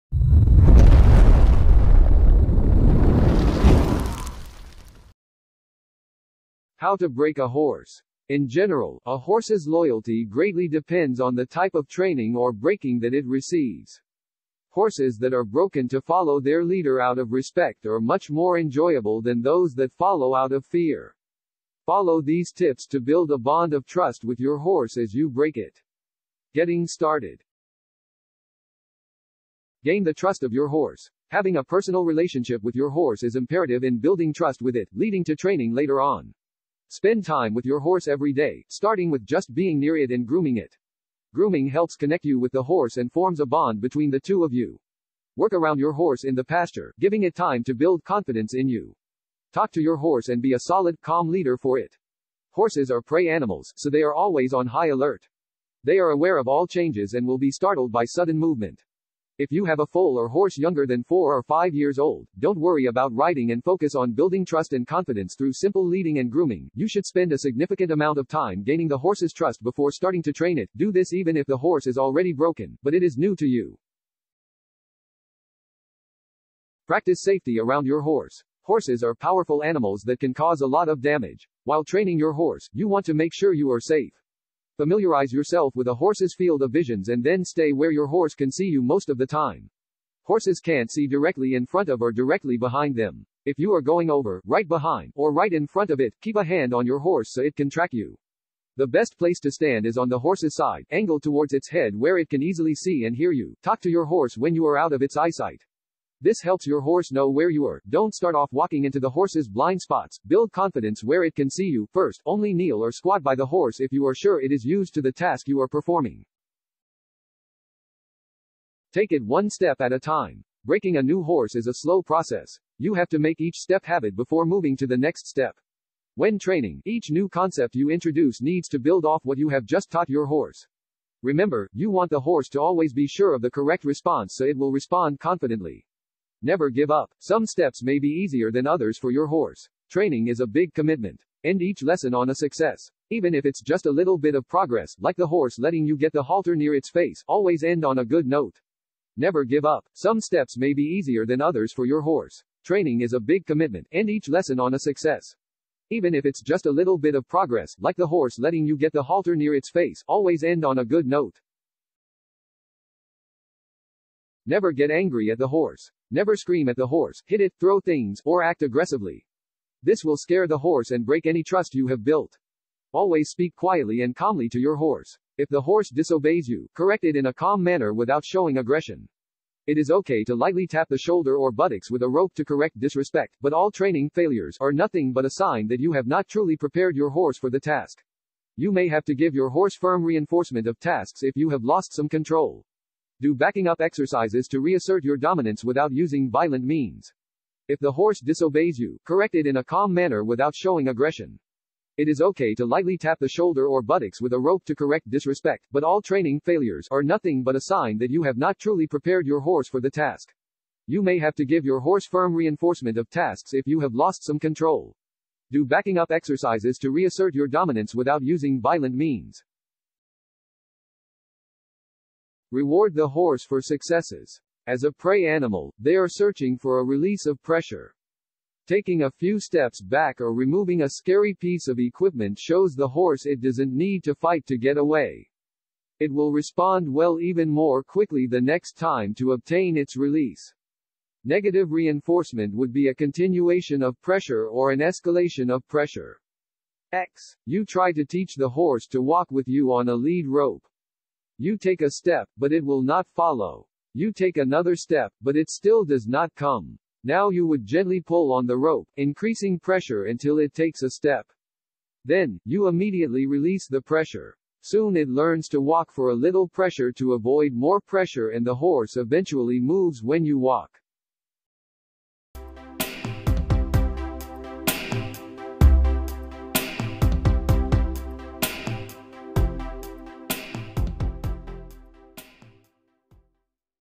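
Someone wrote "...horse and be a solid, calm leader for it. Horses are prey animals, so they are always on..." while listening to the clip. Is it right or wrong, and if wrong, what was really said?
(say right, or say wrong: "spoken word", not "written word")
right.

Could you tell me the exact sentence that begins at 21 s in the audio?
Follow these tips to build a bond of trust with your horse as you break it.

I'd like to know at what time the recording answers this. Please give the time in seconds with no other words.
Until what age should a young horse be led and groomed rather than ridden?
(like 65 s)
61 s.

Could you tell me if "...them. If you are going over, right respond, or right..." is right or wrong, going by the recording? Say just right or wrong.
wrong.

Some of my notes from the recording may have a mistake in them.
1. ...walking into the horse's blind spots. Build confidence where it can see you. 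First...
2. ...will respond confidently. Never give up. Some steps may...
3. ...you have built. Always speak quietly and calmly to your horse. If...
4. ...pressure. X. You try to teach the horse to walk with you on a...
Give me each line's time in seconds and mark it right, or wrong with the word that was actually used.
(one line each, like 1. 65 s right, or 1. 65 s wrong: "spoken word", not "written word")
1. 108 s right
2. 134 s right
3. 171 s right
4. 245 s right.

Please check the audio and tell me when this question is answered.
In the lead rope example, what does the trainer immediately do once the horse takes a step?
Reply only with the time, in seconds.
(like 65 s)
263 s.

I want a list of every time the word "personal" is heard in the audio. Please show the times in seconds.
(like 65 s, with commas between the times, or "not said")
31 s.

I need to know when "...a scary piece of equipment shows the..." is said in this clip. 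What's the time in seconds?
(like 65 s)
230 s.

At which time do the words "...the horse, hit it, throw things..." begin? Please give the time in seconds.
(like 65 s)
166 s.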